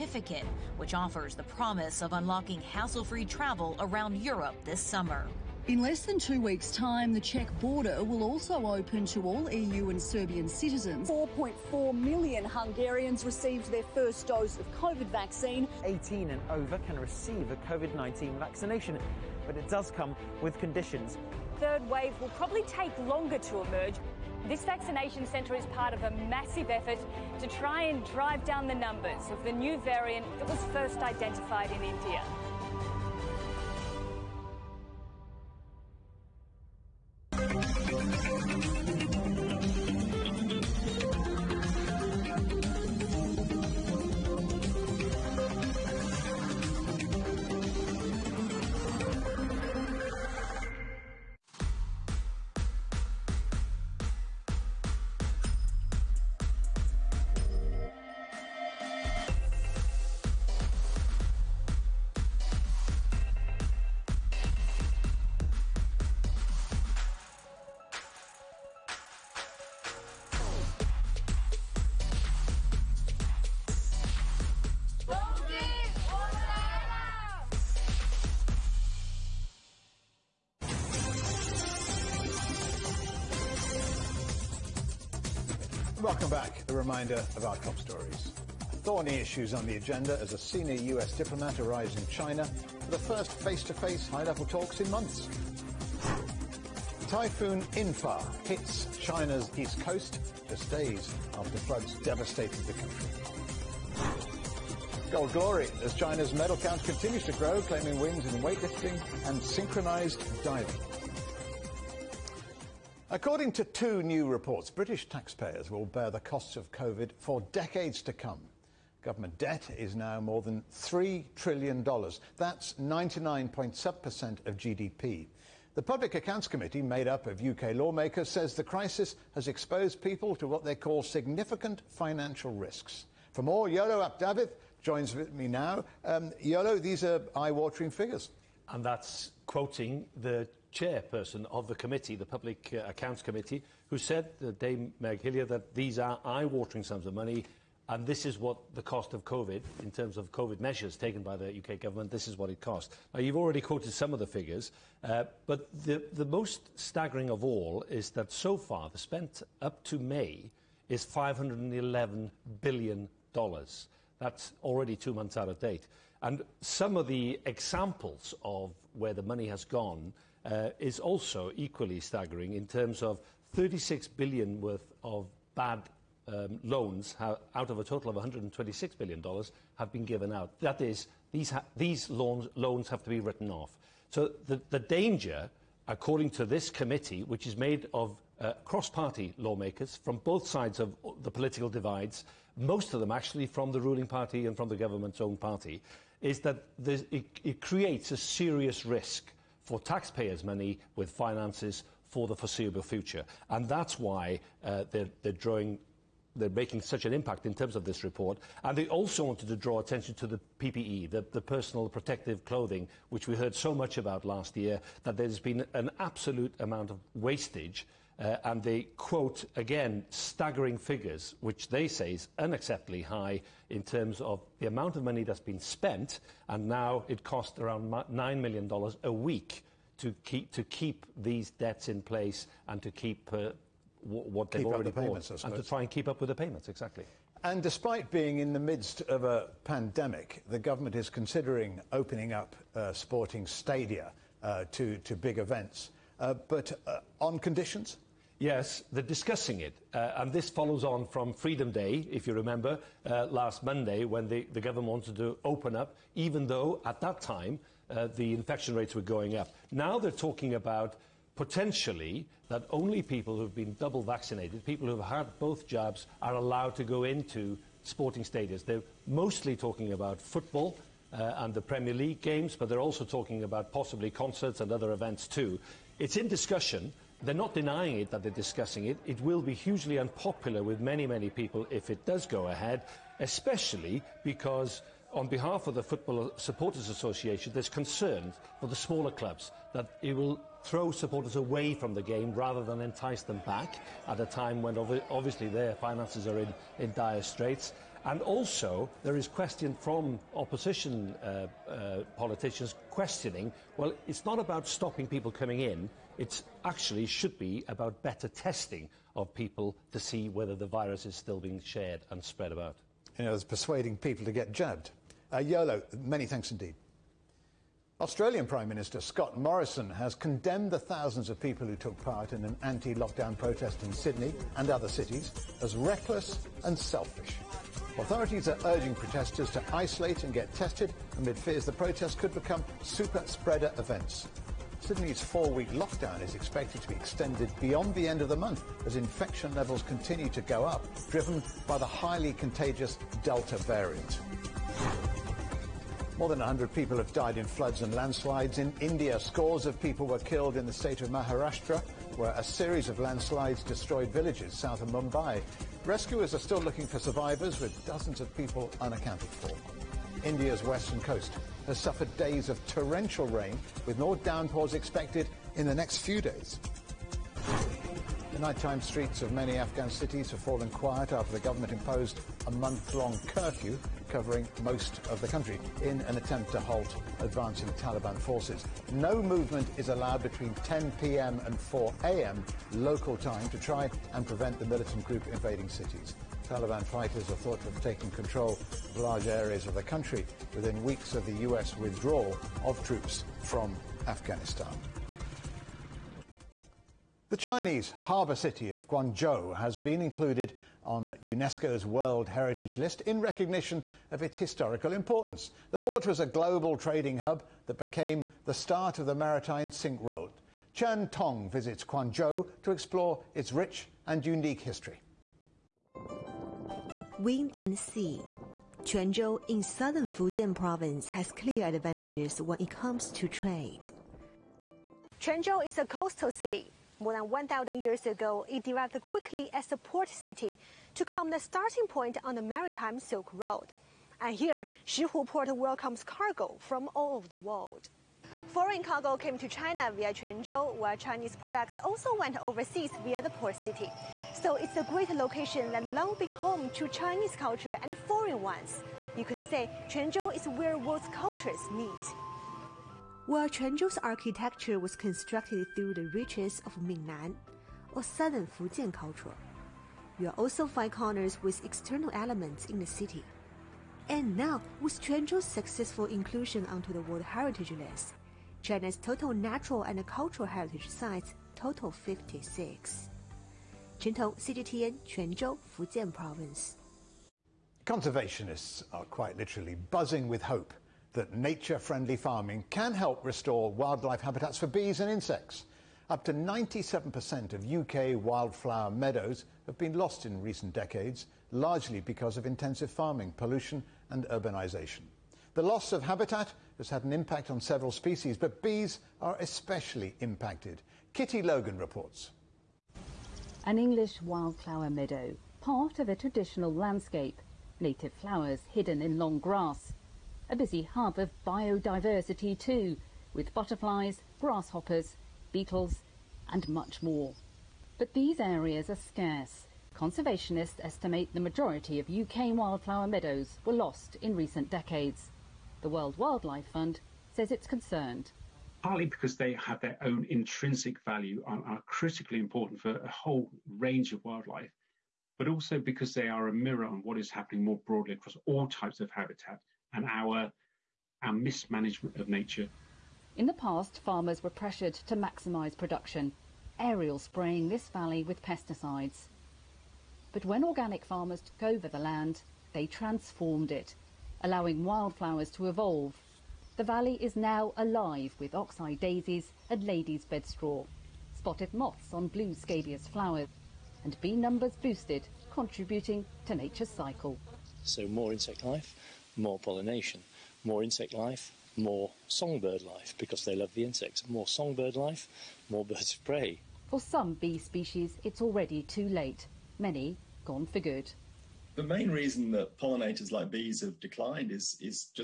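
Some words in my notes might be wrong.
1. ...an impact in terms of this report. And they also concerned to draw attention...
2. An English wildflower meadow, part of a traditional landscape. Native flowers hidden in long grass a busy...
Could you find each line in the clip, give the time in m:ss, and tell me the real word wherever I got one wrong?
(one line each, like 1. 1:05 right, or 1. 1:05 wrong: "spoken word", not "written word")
1. 3:27 wrong: "wanted", not "concerned"
2. 8:23 right.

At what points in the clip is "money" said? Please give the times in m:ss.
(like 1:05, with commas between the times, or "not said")
2:27, 2:49, 3:20, 3:45.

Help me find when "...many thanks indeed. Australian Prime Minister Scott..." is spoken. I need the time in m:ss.
5:16.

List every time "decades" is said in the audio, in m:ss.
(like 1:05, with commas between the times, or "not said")
1:57, 8:10, 8:44.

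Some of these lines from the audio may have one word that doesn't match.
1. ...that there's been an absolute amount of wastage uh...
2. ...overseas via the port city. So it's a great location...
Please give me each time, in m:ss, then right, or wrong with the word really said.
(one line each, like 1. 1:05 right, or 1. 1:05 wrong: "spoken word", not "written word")
1. 3:35 right
2. 7:22 right.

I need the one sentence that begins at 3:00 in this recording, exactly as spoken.
That is, these, loans, have to be written off.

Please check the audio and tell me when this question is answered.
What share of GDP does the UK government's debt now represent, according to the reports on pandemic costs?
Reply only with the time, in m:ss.
2:02.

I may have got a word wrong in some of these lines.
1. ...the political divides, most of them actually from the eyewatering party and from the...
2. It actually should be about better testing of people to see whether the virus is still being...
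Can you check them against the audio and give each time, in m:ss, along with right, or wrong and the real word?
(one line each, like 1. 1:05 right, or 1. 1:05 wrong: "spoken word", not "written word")
1. 3:11 wrong: "ruling", not "eyewatering"
2. 5:06 right.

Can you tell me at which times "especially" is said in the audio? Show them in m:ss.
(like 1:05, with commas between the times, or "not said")
4:43, 8:19.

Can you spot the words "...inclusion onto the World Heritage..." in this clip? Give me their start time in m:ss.
7:46.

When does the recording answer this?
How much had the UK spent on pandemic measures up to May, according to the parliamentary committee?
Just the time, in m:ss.
2:41.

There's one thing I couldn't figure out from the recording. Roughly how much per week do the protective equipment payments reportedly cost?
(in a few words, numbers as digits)
$9 million.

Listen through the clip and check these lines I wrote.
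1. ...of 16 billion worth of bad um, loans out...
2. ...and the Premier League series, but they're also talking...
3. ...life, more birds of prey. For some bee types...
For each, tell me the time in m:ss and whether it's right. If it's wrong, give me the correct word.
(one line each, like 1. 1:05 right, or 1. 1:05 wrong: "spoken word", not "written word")
1. 2:53 wrong: "36", not "16"
2. 4:31 wrong: "games", not "series"
3. 9:34 wrong: "species", not "types".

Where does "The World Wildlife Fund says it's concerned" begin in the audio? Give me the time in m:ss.
8:45.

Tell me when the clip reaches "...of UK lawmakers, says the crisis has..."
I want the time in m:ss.
2:07.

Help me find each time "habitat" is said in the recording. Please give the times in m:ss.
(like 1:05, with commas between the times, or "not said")
8:04, 8:16, 8:59.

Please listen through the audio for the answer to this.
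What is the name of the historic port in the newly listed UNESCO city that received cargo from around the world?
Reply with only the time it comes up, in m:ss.
7:14.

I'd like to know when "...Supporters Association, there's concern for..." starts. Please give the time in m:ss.
4:46.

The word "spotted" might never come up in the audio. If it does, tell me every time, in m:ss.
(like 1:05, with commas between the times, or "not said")
9:21.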